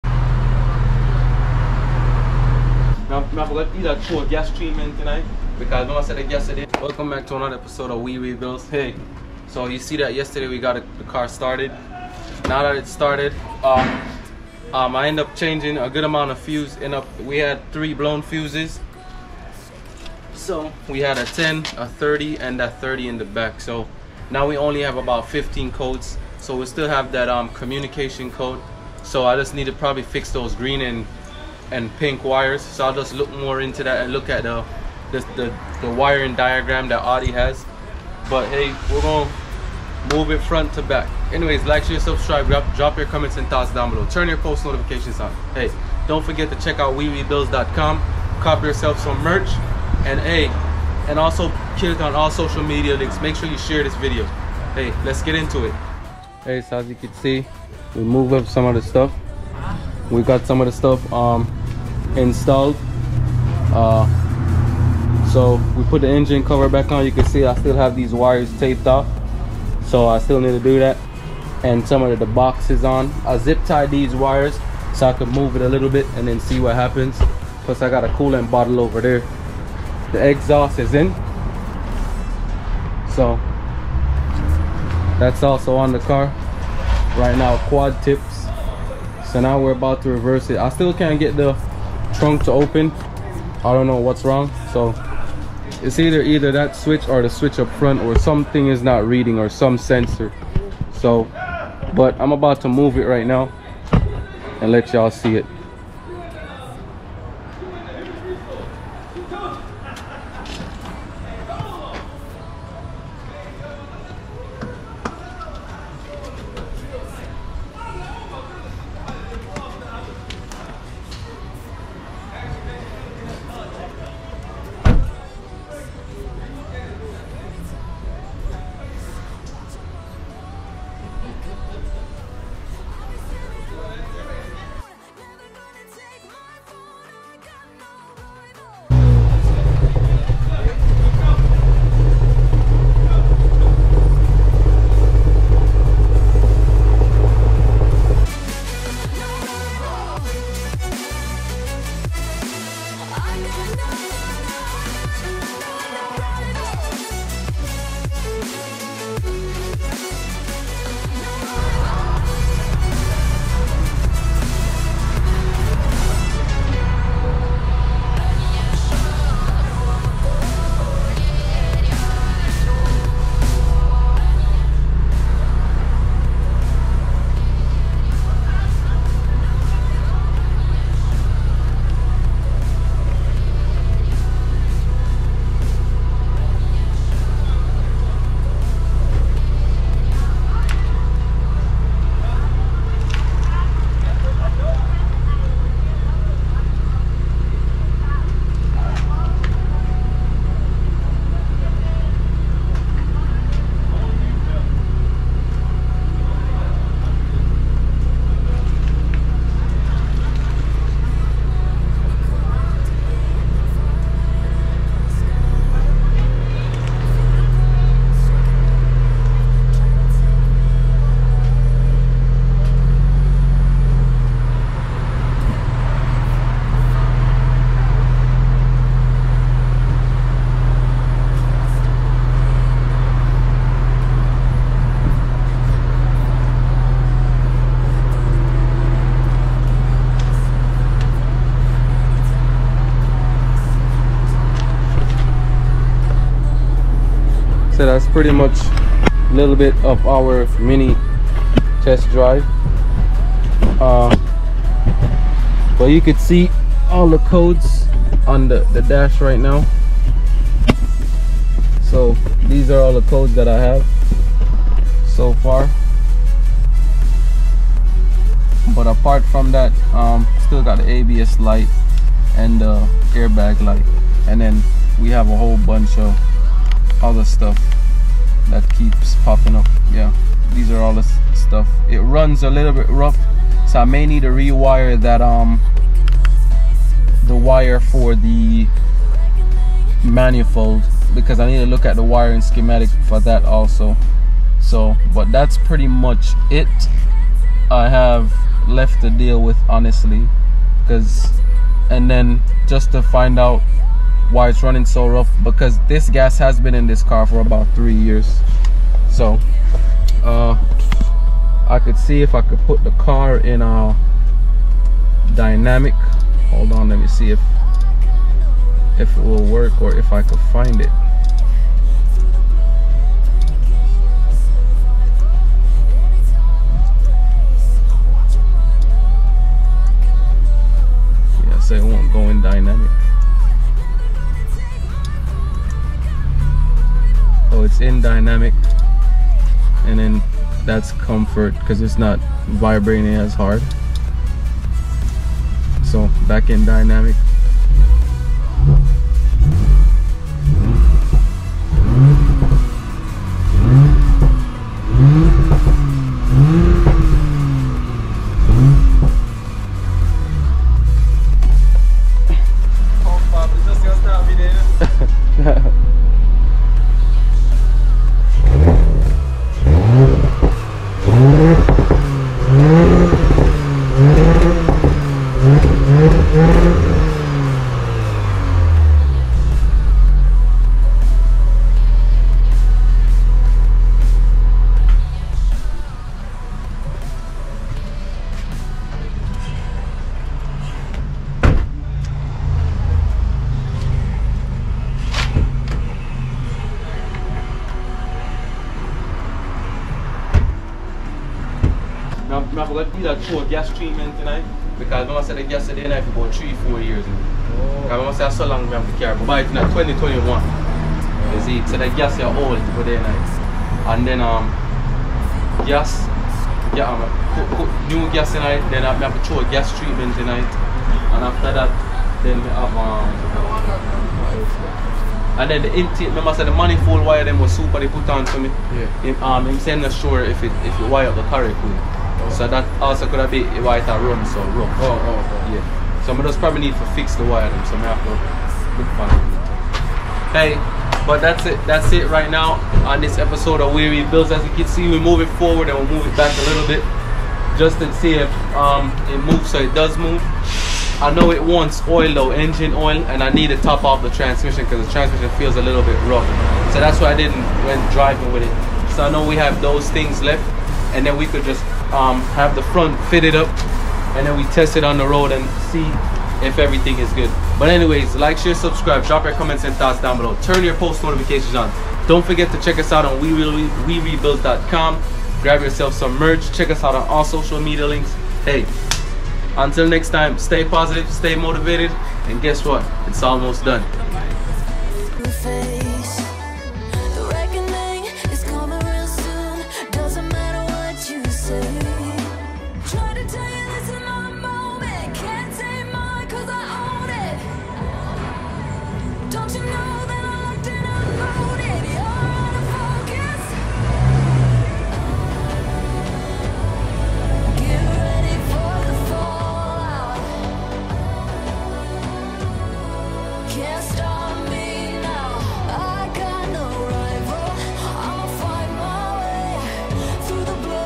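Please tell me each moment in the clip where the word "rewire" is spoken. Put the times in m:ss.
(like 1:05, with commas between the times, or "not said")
4:44.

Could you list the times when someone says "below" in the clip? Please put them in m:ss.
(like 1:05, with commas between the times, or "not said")
0:43, 7:50.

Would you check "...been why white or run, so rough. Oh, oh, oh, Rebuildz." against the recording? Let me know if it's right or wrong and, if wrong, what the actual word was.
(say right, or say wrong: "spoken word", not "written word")
wrong: "Yeah", not "Rebuildz".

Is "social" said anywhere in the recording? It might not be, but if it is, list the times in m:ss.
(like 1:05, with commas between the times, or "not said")
0:52, 7:57.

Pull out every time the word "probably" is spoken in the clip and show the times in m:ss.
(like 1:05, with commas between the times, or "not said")
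0:29, 7:16.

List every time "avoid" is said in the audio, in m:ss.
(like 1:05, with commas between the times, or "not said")
not said.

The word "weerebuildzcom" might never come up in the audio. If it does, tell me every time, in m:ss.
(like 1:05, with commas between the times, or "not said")
0:46, 7:53.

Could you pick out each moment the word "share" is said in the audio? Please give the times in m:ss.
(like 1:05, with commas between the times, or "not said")
0:41, 0:53, 7:48.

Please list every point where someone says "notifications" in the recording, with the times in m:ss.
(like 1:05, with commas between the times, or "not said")
0:44, 7:51.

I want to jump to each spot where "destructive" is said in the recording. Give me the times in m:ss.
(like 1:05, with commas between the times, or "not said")
not said.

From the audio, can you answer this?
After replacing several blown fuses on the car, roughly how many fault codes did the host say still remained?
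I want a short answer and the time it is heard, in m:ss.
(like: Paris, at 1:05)
15, at 0:25.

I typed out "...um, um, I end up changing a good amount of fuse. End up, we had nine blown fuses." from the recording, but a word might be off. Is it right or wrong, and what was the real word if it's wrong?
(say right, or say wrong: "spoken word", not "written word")
wrong: "three", not "nine".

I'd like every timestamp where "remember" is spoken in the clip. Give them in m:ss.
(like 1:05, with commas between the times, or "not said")
6:47, 7:06.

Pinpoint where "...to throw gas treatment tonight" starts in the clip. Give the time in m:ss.
6:59.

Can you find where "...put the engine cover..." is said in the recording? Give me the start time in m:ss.
1:05.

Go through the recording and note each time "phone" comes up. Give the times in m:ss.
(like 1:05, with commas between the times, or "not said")
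not said.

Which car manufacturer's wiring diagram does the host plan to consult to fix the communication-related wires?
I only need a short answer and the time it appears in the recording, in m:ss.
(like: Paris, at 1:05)
Audi, at 0:37.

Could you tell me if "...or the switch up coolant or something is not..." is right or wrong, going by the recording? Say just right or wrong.
wrong.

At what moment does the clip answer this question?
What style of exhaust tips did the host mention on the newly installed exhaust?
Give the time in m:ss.
1:27.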